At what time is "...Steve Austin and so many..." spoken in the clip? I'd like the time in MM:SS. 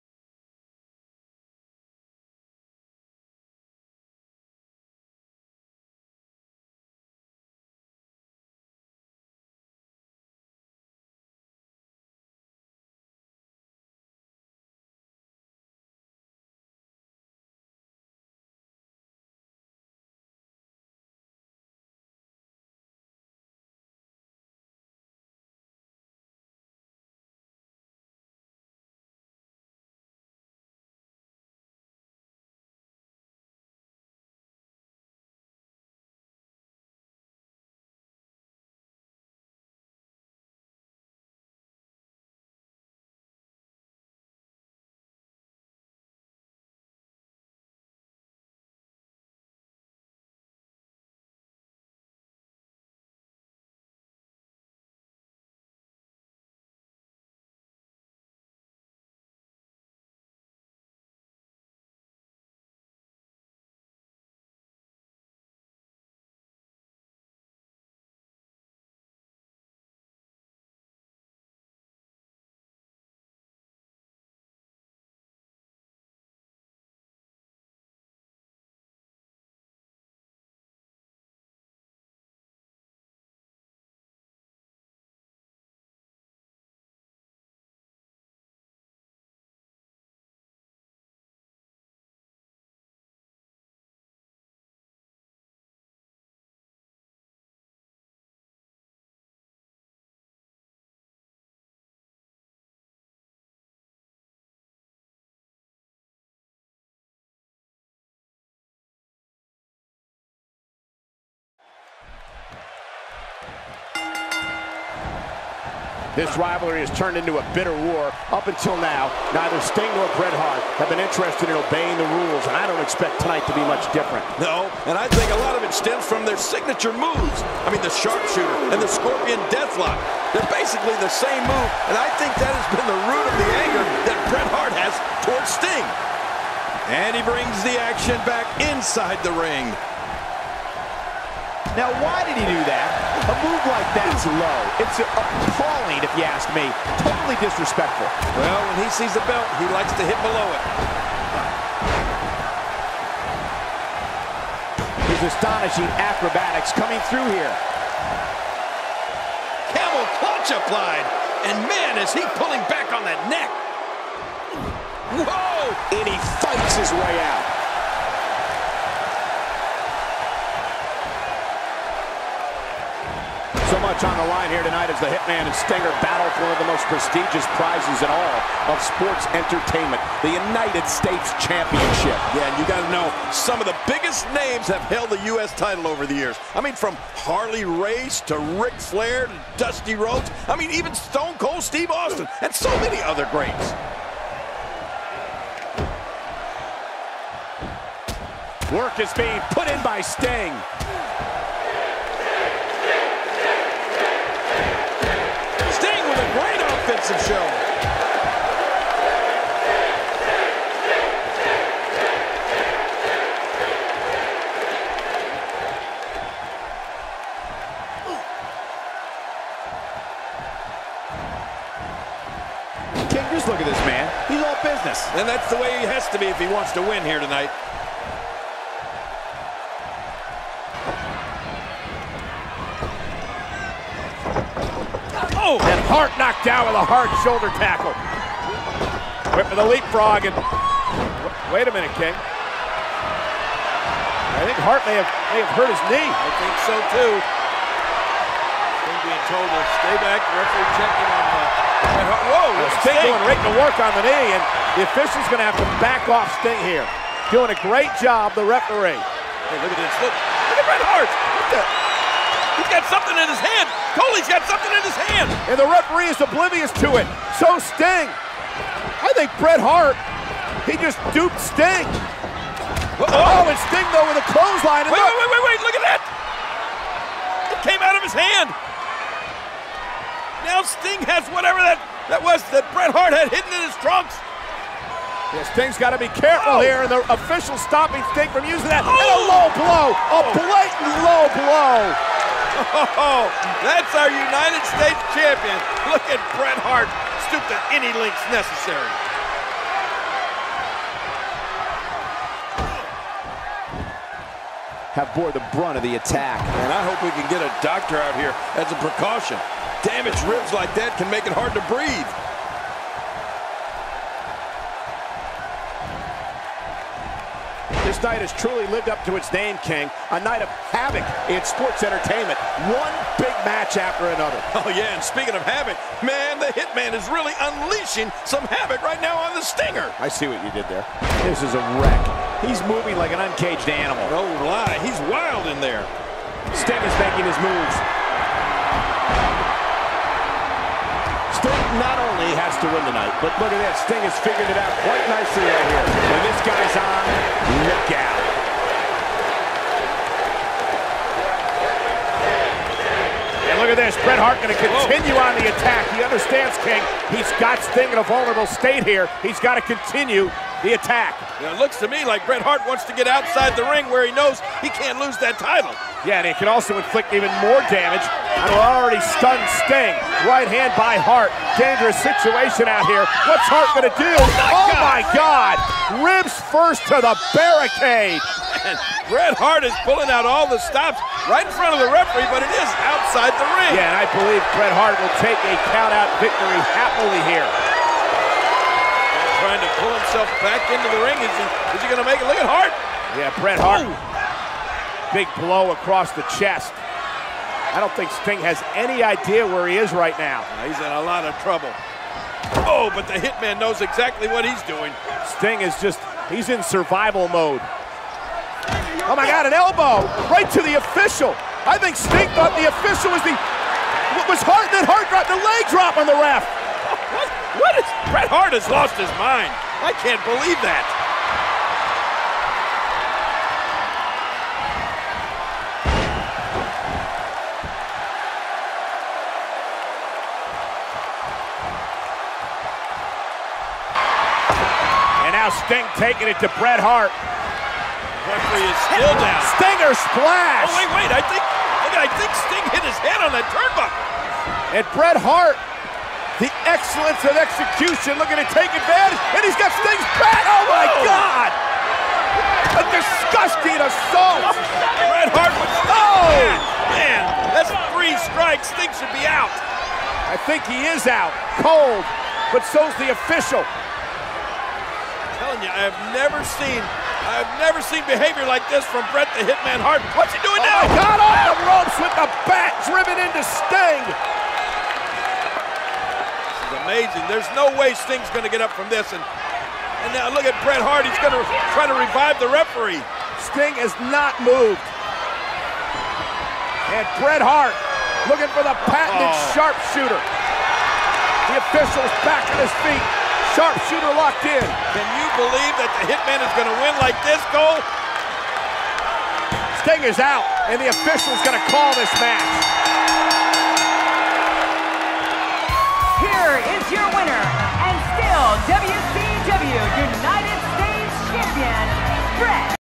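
03:11.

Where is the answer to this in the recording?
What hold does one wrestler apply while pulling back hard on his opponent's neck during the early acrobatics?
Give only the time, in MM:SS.
02:39.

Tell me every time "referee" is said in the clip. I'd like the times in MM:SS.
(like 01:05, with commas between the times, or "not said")
04:10, 04:18, 04:25, 06:21, 07:17, 08:02.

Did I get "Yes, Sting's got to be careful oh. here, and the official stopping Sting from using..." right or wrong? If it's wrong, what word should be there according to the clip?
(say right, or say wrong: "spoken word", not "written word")
right.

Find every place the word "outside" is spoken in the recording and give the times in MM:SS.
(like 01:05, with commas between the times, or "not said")
06:03, 06:22.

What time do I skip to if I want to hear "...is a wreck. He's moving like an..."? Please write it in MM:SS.
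05:31.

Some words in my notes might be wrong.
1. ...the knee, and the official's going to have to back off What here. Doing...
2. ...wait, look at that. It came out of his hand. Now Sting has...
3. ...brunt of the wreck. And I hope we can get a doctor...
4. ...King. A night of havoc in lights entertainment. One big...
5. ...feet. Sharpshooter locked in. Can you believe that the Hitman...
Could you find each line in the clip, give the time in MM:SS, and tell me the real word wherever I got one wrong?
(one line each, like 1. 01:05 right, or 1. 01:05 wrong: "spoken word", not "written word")
1. 04:13 wrong: "Sting", not "What"
2. 04:35 right
3. 05:05 wrong: "attack", not "wreck"
4. 05:19 wrong: "sports", not "lights"
5. 08:12 right.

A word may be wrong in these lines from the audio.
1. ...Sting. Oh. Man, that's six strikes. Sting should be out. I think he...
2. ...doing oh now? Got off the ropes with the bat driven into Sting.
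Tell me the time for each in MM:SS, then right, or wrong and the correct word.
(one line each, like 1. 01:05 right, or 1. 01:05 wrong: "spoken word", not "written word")
1. 07:35 wrong: "three", not "six"
2. 07:50 right.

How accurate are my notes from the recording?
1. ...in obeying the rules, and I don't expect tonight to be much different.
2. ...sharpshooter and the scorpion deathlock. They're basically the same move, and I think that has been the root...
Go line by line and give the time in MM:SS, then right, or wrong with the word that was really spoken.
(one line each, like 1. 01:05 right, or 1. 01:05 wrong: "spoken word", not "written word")
1. 02:01 right
2. 02:07 right.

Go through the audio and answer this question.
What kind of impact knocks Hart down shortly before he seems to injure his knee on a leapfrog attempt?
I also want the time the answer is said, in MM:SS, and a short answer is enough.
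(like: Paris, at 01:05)
Shoulder tackle, at 03:57.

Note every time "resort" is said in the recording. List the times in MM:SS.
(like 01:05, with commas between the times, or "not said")
not said.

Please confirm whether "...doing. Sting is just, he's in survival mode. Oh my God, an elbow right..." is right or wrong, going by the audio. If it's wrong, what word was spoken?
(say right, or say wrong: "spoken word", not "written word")
right.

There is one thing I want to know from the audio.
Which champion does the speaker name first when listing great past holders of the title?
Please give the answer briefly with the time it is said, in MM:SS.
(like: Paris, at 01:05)
Harley Race, at 03:07.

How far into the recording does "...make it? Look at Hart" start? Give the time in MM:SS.
06:32.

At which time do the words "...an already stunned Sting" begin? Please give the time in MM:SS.
06:08.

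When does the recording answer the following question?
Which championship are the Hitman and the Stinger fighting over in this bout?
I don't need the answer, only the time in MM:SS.
03:00.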